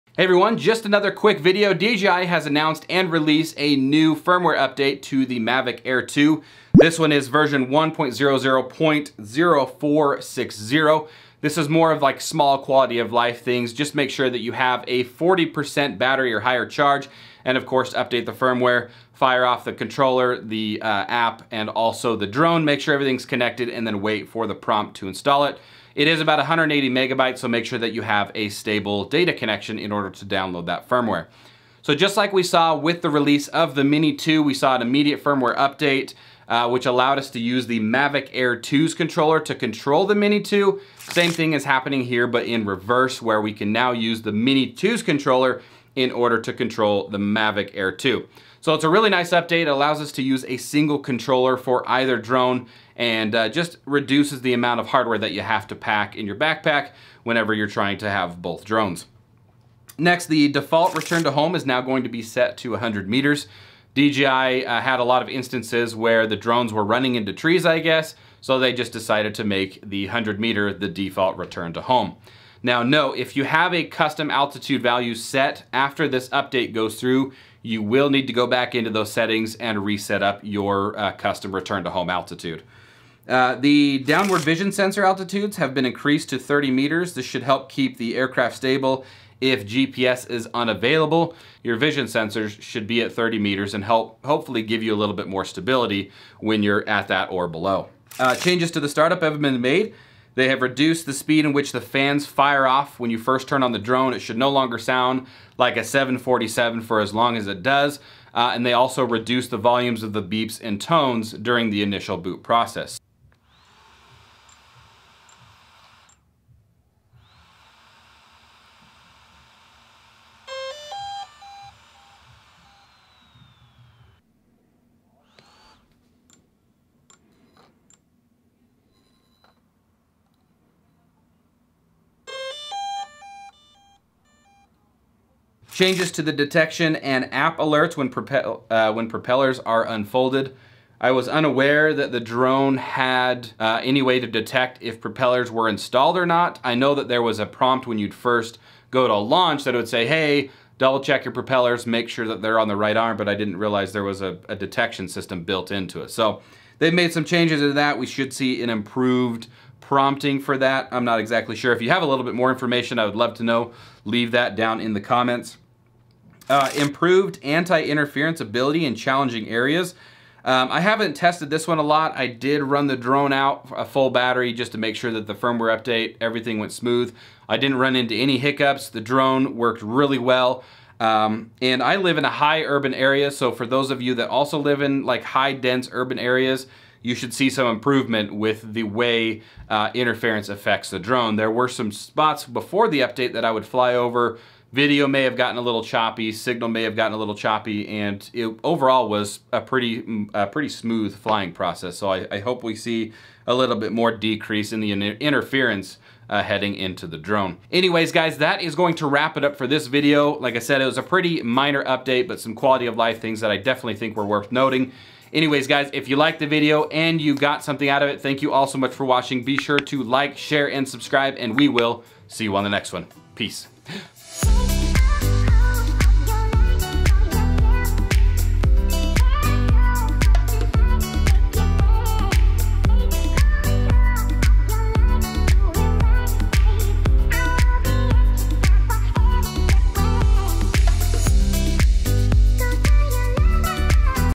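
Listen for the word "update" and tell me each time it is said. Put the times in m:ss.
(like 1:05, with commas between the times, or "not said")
0:04, 0:17, 0:35, 0:49, 1:16, 2:55, 3:13, 3:31.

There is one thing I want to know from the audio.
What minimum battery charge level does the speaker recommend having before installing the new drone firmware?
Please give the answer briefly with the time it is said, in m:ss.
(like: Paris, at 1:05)
40%, at 0:15.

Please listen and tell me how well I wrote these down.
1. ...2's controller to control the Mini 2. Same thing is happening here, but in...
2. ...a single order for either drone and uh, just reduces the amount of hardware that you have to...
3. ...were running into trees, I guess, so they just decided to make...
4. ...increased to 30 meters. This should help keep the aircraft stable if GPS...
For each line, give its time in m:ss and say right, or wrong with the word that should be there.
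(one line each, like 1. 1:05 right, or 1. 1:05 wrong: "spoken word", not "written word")
1. 0:38 right
2. 0:50 wrong: "controller", not "order"
3. 1:06 right
4. 1:25 right.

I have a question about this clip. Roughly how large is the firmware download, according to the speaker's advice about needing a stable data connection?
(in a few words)
180 megabytes.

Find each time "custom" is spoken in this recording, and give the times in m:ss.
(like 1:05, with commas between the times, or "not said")
1:13, 1:21.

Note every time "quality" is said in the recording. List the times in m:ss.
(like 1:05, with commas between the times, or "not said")
0:12, 3:32.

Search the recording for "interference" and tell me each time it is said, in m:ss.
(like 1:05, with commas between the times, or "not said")
2:47, 3:09, 3:25.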